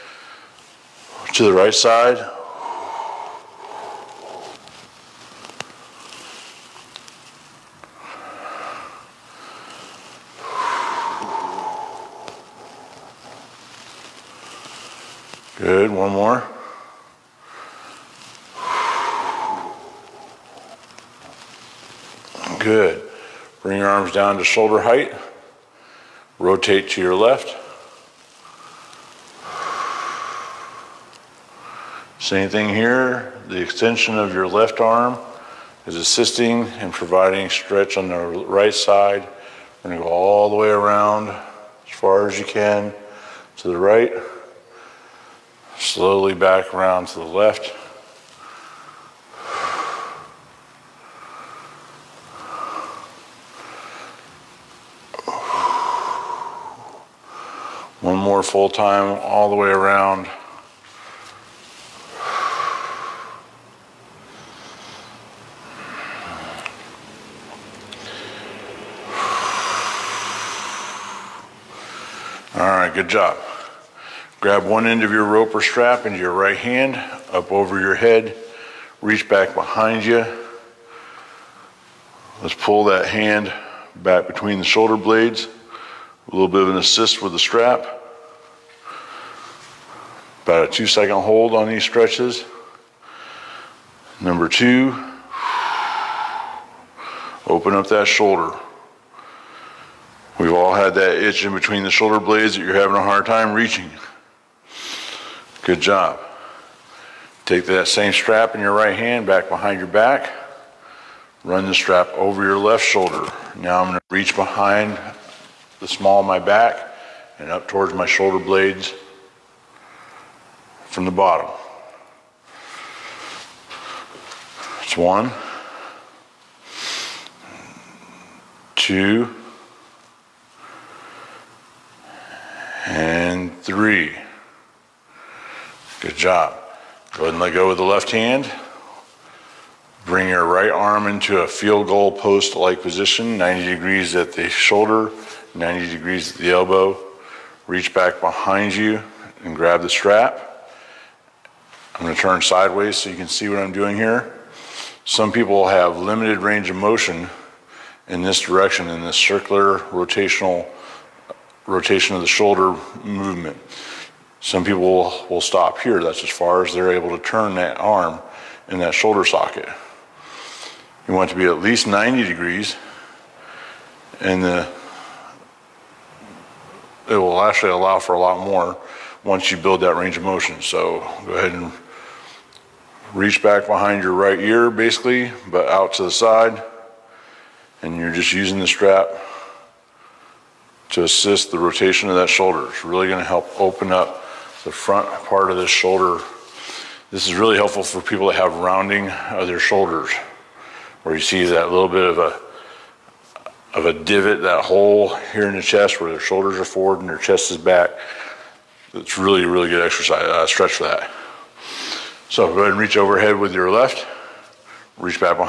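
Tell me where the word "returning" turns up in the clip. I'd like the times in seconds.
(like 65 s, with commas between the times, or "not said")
not said.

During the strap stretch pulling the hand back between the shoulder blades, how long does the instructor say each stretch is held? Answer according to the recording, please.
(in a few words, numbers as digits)
2 seconds.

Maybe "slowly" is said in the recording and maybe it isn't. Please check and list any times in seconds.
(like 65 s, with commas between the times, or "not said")
45 s.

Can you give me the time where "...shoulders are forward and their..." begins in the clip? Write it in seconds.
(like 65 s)
206 s.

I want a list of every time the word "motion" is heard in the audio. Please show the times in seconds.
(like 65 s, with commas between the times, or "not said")
156 s, 180 s.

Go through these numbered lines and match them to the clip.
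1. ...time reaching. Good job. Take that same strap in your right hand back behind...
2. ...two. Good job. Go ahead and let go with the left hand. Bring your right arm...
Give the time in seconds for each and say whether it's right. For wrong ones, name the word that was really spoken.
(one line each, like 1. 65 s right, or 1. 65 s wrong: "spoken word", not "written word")
1. 103 s right
2. 133 s wrong: "three", not "two".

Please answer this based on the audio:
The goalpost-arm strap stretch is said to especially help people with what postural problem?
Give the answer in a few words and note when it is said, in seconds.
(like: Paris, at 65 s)
rounding of their shoulders, at 198 s.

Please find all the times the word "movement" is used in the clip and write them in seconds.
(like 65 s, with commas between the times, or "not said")
163 s.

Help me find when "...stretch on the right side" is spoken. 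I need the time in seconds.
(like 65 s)
37 s.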